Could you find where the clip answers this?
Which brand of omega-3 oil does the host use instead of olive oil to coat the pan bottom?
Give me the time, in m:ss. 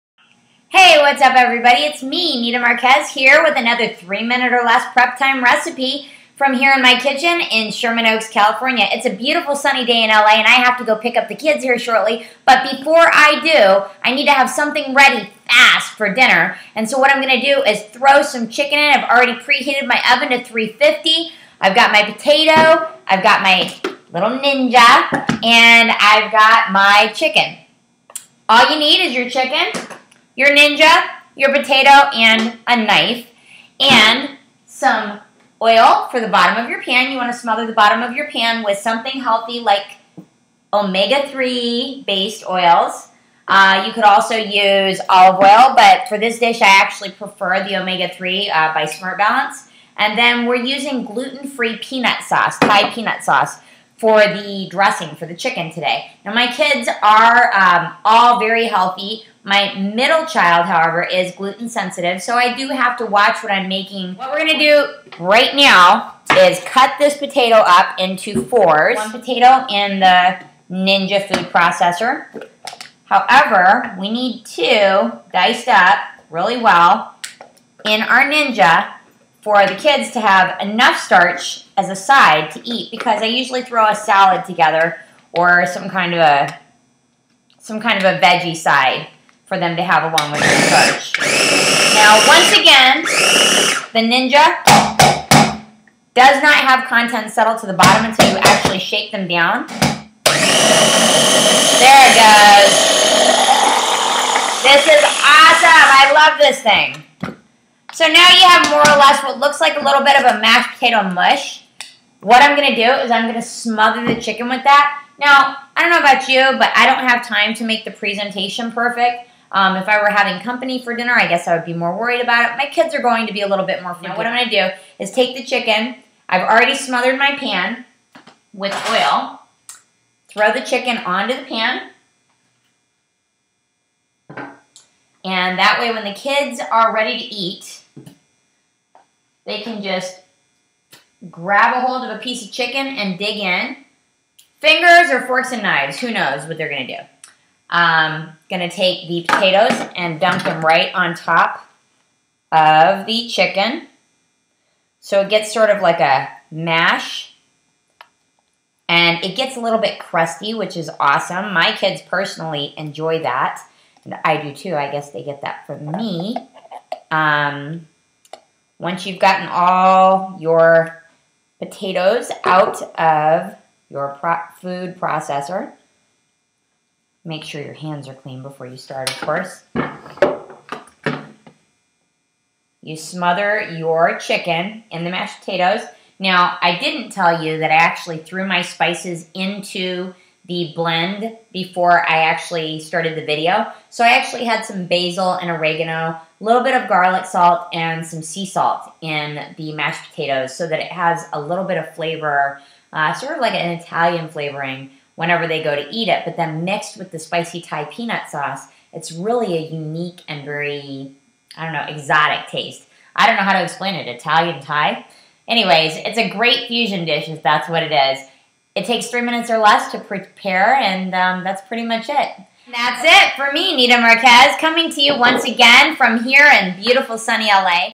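0:48.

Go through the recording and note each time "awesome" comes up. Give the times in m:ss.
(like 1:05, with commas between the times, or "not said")
1:45, 2:40.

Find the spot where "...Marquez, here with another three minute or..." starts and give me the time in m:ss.
0:02.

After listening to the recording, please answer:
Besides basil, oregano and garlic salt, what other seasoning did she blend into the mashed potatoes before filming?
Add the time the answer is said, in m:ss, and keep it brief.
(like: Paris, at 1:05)
sea salt, at 3:18.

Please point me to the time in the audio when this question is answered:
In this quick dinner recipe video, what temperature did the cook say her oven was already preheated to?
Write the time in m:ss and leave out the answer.
0:20.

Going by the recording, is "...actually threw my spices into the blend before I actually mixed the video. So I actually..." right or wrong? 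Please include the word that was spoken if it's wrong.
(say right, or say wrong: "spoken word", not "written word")
wrong: "started", not "mixed".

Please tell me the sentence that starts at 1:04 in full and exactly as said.
What we're gonna do right now is cut this potato up into fours.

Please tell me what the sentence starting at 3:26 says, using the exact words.
But then mixed with the spicy Thai peanut sauce, it's really a unique and very, I don't know, exotic taste.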